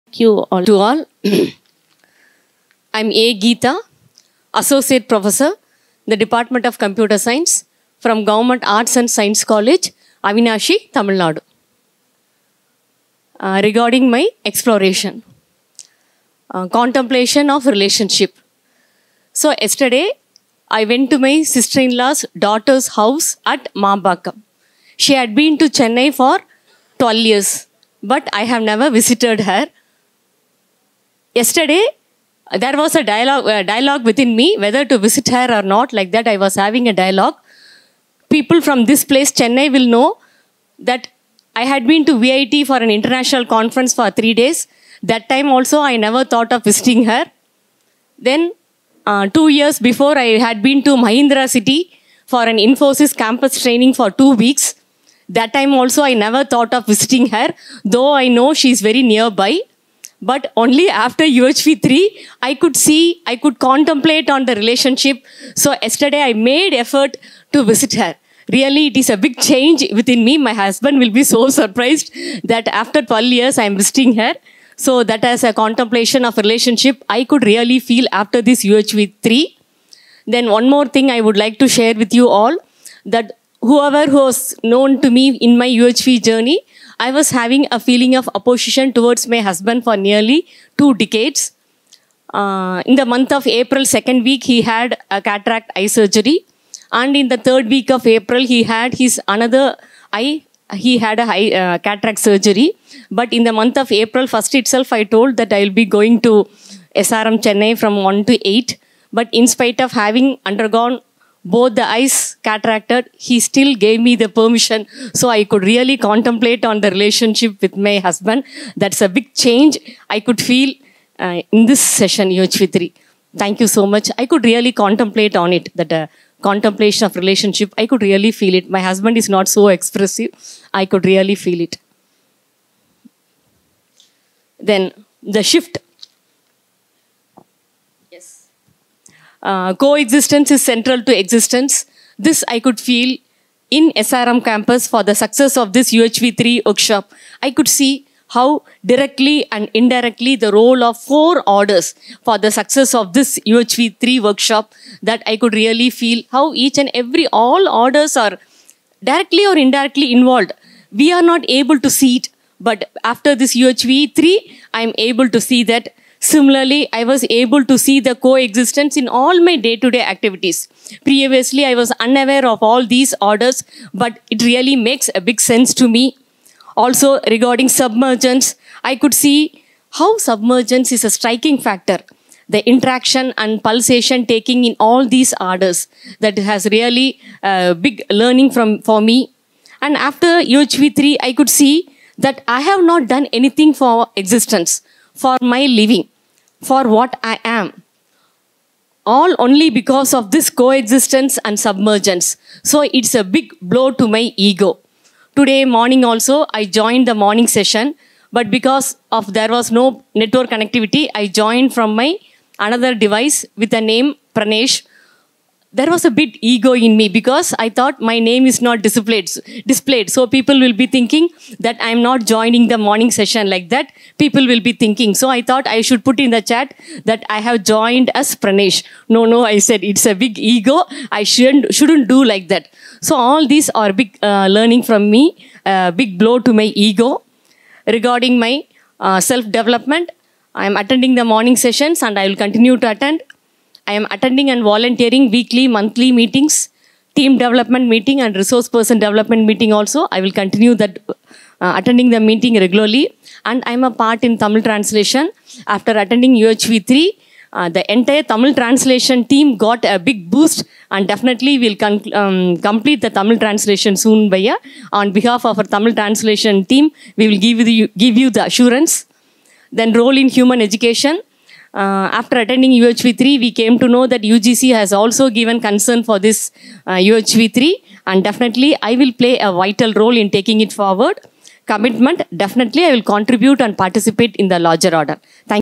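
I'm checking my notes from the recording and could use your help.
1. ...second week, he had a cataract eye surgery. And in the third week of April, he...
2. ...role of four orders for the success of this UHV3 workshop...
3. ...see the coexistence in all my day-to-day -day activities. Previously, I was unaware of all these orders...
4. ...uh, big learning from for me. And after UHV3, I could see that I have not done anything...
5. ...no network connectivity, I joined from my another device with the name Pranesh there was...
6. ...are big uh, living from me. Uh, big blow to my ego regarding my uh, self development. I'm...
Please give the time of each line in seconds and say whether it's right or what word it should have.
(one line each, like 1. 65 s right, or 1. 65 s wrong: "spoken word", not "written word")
1. 93 s right
2. 150 s right
3. 167 s right
4. 187 s right
5. 209 s right
6. 233 s wrong: "learning", not "living".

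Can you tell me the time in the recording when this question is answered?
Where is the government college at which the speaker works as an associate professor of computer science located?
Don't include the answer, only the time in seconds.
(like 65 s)
10 s.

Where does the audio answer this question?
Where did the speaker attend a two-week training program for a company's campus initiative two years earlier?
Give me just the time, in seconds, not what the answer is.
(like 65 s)
51 s.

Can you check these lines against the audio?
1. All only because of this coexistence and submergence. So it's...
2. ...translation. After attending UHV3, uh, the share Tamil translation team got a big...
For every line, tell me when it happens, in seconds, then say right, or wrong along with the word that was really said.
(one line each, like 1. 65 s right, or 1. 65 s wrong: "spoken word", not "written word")
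1. 199 s right
2. 254 s wrong: "entire", not "share".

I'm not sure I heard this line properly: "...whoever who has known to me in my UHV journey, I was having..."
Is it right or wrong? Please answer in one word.
right.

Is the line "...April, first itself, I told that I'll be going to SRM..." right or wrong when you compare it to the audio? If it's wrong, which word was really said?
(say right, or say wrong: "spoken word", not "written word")
right.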